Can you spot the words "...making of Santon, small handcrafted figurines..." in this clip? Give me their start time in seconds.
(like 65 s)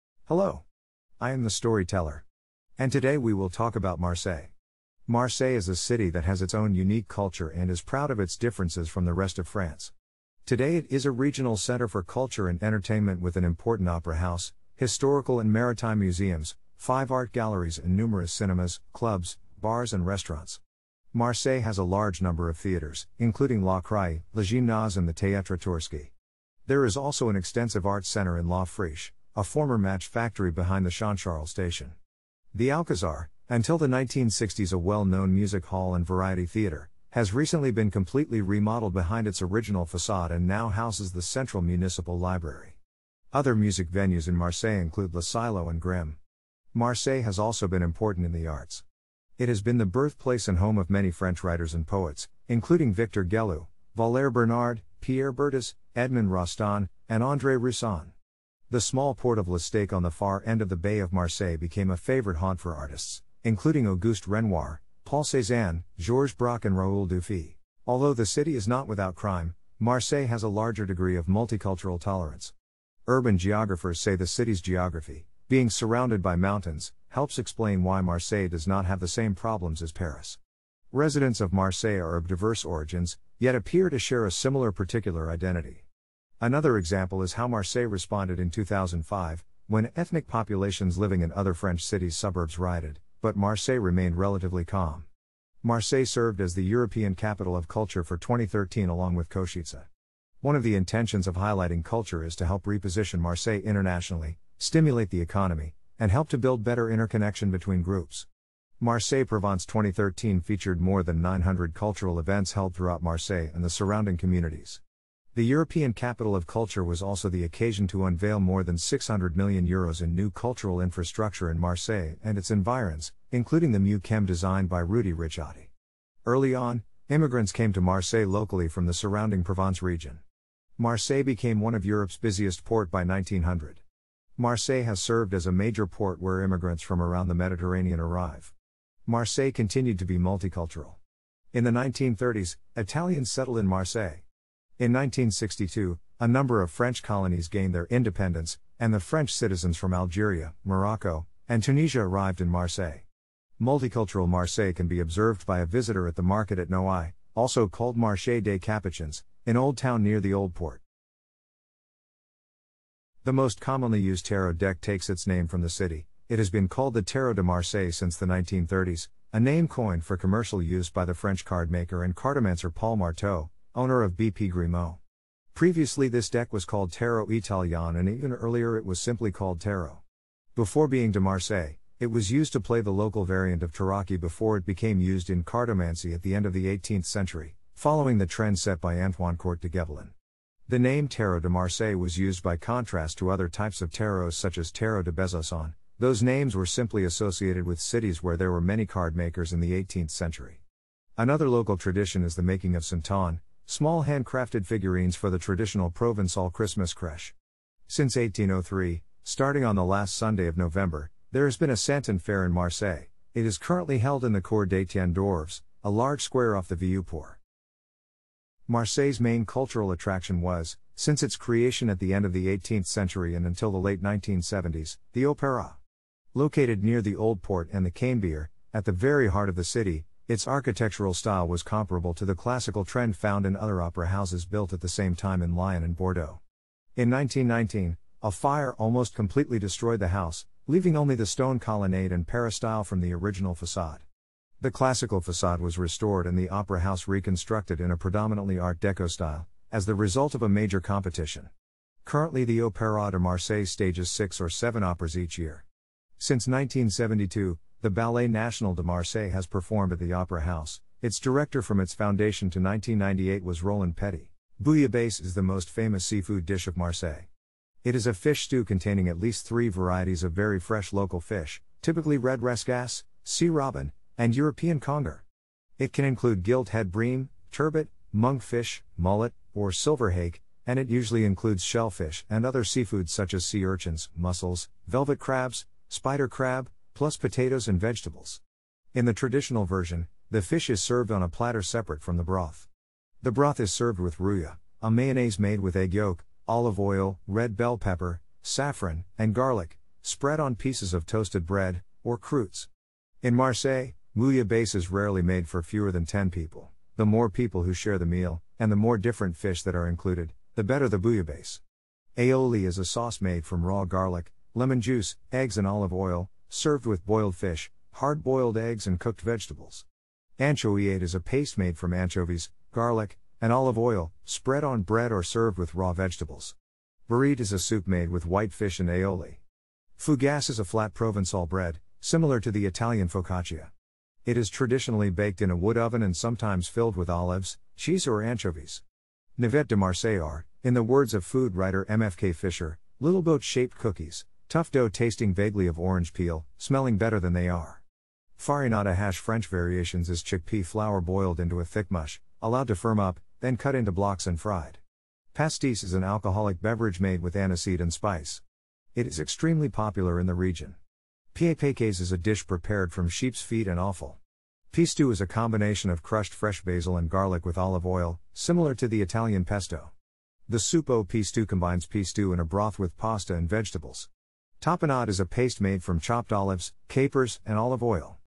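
202 s.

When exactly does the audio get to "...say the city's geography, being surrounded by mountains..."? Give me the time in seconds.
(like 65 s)
73 s.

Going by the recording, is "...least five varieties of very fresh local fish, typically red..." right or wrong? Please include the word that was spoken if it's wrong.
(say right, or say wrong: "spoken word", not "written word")
wrong: "three", not "five".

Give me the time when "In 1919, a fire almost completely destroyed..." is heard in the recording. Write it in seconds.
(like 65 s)
236 s.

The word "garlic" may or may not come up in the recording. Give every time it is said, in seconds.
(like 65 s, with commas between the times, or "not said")
299 s, 313 s, 322 s, 367 s.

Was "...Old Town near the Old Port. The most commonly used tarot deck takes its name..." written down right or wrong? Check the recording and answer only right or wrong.
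right.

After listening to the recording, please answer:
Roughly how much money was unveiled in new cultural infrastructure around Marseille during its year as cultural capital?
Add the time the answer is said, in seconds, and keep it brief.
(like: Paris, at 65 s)
600 million euros, at 118 s.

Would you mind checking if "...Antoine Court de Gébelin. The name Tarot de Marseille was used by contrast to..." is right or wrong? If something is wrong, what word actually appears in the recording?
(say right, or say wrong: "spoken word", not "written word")
right.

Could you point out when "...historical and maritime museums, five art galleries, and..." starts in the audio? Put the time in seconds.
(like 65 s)
14 s.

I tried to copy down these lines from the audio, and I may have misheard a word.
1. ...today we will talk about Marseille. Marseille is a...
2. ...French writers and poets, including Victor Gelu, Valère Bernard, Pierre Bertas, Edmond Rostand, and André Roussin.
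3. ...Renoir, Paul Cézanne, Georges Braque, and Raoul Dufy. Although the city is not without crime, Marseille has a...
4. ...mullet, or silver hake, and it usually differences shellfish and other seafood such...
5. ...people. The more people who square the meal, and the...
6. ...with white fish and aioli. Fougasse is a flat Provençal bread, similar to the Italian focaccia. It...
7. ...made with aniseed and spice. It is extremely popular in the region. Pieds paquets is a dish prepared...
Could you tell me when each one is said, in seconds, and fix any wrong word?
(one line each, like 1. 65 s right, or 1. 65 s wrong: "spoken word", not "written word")
1. 2 s right
2. 51 s right
3. 64 s right
4. 278 s wrong: "includes", not "differences"
5. 306 s wrong: "share", not "square"
6. 328 s right
7. 356 s right.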